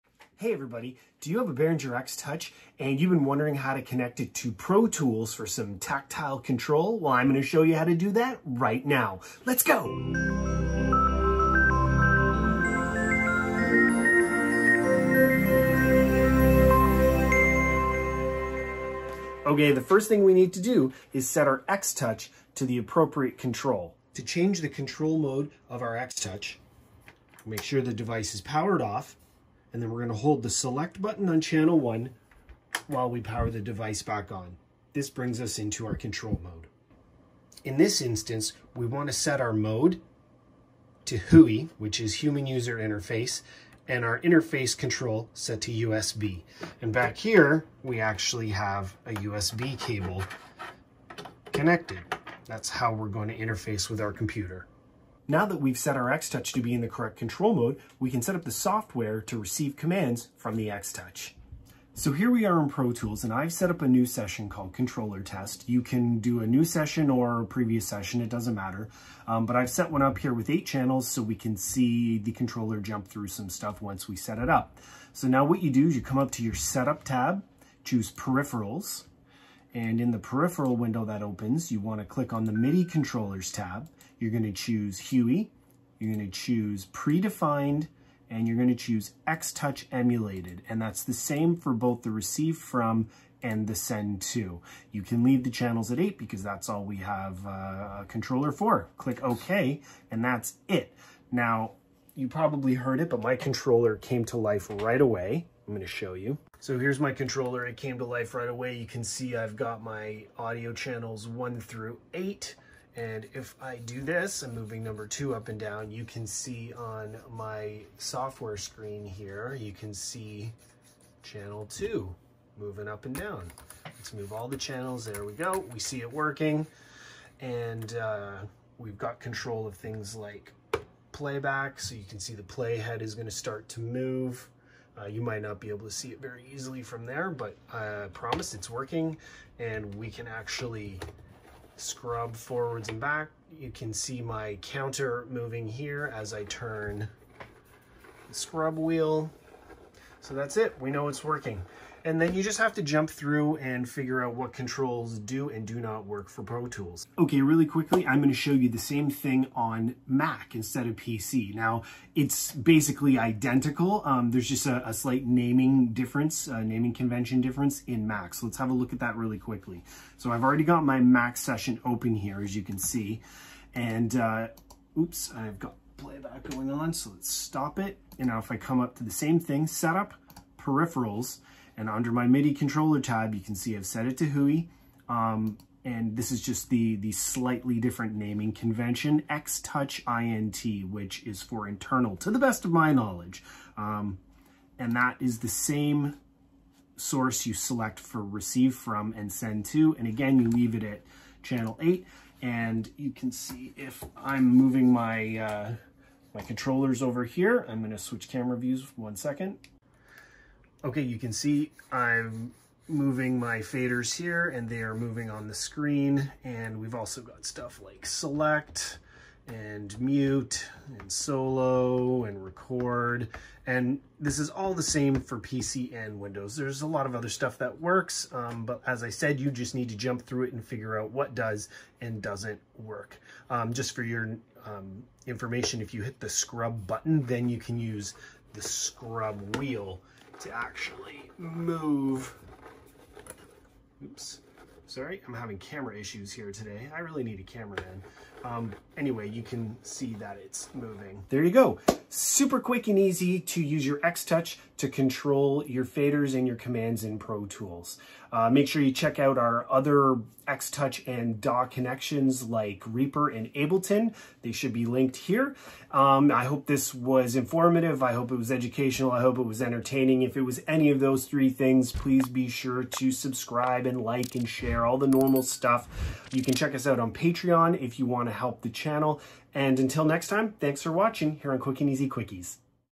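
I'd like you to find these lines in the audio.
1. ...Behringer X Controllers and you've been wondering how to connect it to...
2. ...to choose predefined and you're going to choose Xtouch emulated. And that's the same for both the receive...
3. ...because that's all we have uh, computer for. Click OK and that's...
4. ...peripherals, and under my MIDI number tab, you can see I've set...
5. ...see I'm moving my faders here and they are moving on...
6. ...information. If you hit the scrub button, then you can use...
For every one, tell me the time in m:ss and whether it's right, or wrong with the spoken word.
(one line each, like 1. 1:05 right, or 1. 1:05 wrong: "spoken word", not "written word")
1. 0:01 wrong: "Touch", not "Controllers"
2. 1:26 right
3. 1:36 wrong: "controller", not "computer"
4. 3:00 wrong: "controller", not "number"
5. 3:31 right
6. 3:55 right.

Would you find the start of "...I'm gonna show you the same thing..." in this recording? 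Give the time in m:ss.
2:38.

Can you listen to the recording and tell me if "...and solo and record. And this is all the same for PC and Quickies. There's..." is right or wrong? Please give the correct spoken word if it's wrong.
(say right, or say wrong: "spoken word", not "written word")
wrong: "Windows", not "Quickies".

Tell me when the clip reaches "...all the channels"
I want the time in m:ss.
2:04.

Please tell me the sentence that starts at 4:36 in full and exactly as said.
You can check us out on Patreon if you want to help the channel.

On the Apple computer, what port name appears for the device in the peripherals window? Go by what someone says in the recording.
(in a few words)
X-Touch INT.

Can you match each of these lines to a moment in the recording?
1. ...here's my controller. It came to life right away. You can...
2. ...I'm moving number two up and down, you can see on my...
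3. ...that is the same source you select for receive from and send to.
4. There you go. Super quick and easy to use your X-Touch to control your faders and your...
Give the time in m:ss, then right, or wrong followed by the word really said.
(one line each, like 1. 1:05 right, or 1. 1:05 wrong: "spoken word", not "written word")
1. 1:46 right
2. 1:54 right
3. 3:14 right
4. 4:11 right.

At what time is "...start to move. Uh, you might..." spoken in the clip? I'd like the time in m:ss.
2:13.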